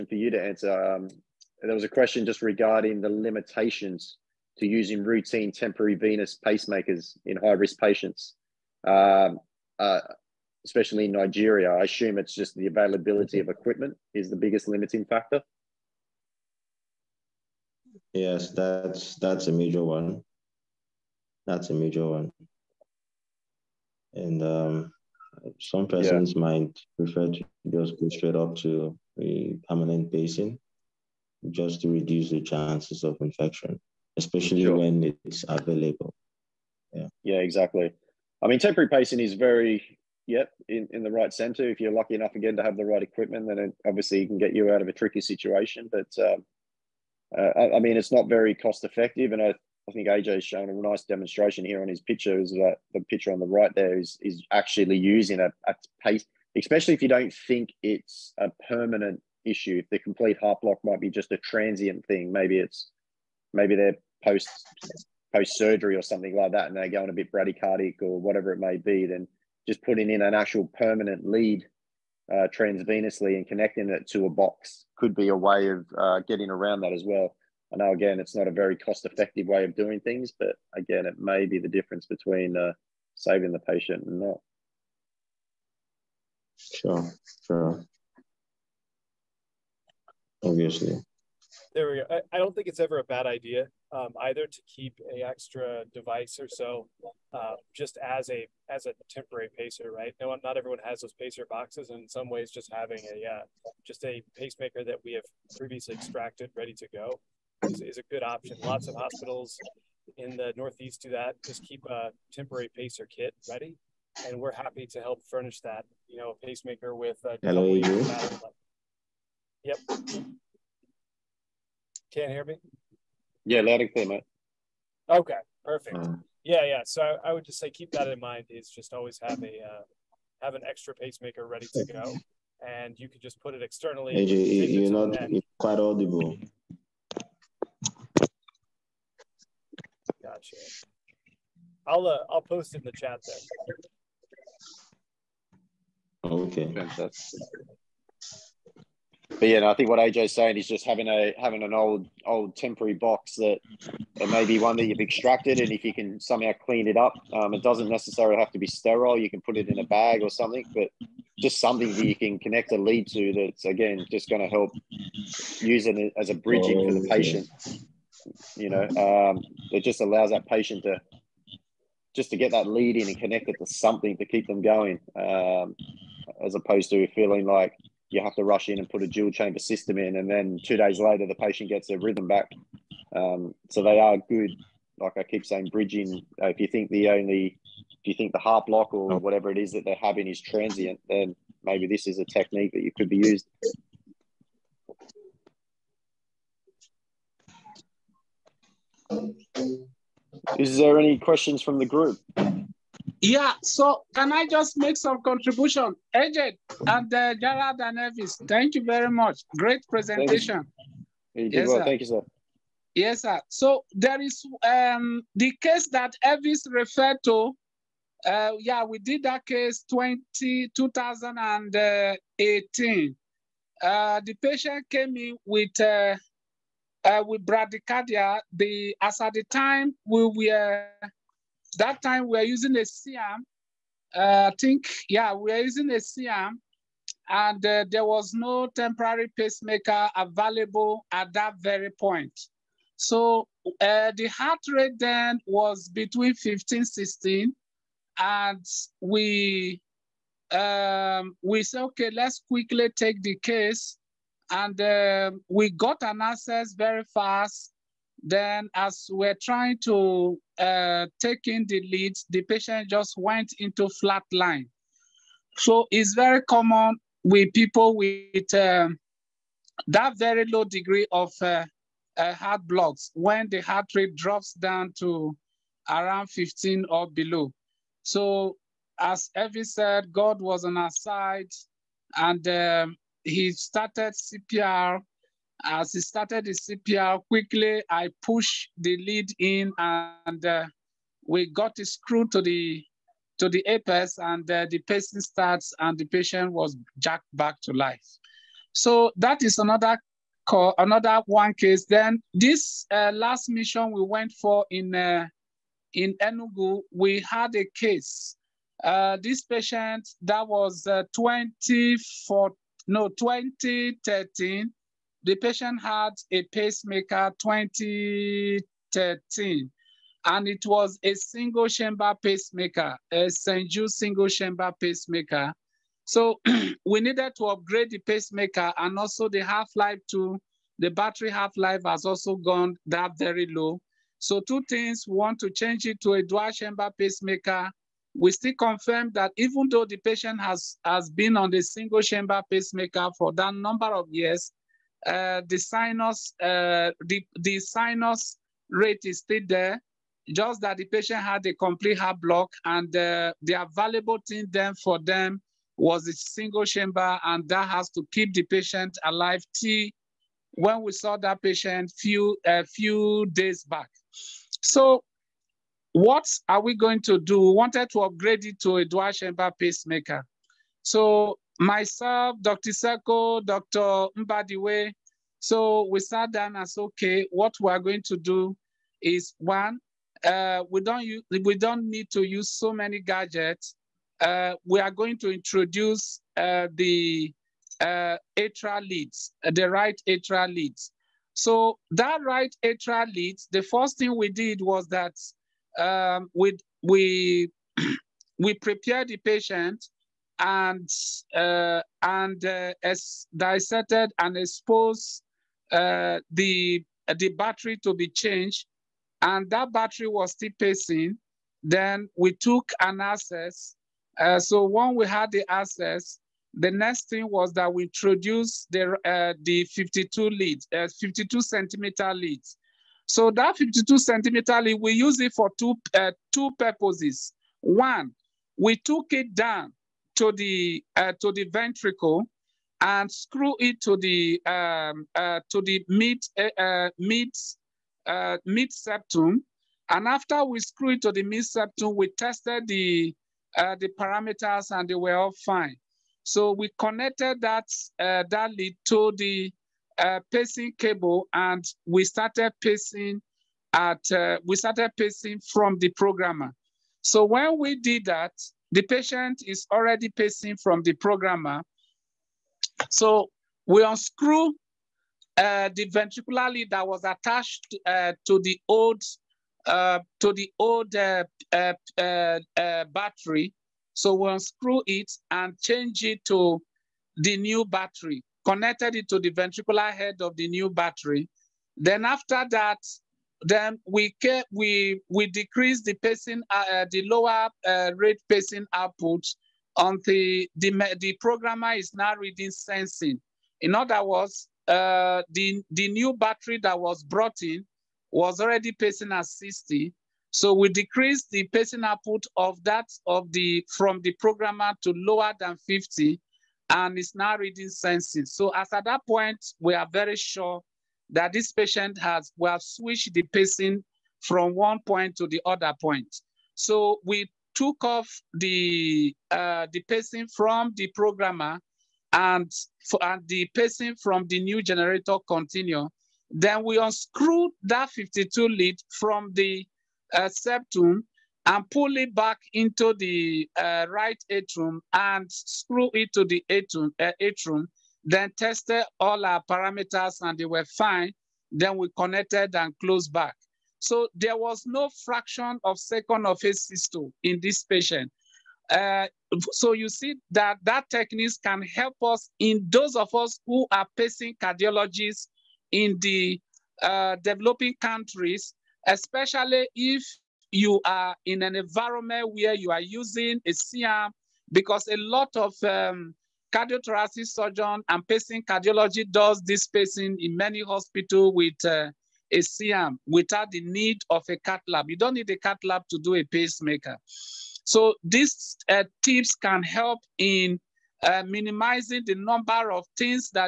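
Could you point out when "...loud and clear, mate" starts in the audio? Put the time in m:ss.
2:03.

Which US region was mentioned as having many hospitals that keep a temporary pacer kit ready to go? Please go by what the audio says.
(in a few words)
The Northeast.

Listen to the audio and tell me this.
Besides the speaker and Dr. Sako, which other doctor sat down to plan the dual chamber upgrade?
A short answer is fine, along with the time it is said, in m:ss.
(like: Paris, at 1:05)
Dr. Mbadiwe, at 6:13.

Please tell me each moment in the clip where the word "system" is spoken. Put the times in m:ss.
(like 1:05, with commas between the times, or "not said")
2:59, 9:06.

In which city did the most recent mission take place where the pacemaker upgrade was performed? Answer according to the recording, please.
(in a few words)
Enugu.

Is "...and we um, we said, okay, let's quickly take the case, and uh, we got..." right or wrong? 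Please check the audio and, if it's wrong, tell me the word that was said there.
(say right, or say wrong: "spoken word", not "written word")
right.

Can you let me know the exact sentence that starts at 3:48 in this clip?
The as at the time we were that time we were using a C-arm.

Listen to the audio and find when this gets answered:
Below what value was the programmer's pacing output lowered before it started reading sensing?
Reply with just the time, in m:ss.
8:25.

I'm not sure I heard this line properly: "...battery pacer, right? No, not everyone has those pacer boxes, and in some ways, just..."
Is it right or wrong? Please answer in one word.
wrong.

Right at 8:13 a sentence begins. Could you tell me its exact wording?
In other words, uh, the the new battery that was brought in was already pacing at 60.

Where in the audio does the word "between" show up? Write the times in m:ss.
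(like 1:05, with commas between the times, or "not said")
1:22, 4:05.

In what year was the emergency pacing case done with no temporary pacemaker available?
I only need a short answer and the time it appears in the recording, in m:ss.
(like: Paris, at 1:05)
2018, at 3:40.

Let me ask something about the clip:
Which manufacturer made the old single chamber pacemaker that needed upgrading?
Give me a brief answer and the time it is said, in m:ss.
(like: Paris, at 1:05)
St. Jude, at 5:23.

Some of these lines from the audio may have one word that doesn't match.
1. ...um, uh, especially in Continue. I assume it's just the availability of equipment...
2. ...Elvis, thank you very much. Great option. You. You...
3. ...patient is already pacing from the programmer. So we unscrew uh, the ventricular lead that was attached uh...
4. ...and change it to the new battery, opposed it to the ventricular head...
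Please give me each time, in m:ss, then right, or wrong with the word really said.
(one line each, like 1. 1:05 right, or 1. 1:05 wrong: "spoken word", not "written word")
1. 0:08 wrong: "Nigeria", not "Continue"
2. 3:27 wrong: "presentation", not "option"
3. 7:38 right
4. 7:55 wrong: "connected", not "opposed".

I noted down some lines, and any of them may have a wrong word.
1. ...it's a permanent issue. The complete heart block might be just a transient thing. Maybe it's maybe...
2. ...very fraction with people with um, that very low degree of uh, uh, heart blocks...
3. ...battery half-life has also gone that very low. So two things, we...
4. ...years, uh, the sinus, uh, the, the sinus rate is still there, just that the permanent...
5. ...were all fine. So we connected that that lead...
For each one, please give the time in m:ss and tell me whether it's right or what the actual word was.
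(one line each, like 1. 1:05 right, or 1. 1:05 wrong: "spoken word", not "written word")
1. 0:57 right
2. 4:26 wrong: "common", not "fraction"
3. 5:30 right
4. 5:44 wrong: "patient", not "permanent"
5. 7:24 right.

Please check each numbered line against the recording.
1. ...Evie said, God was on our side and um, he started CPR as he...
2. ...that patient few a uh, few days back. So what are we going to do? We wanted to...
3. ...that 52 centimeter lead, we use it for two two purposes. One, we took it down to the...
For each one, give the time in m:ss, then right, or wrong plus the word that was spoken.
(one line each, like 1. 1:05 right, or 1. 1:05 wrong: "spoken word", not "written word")
1. 4:39 right
2. 6:01 right
3. 7:03 right.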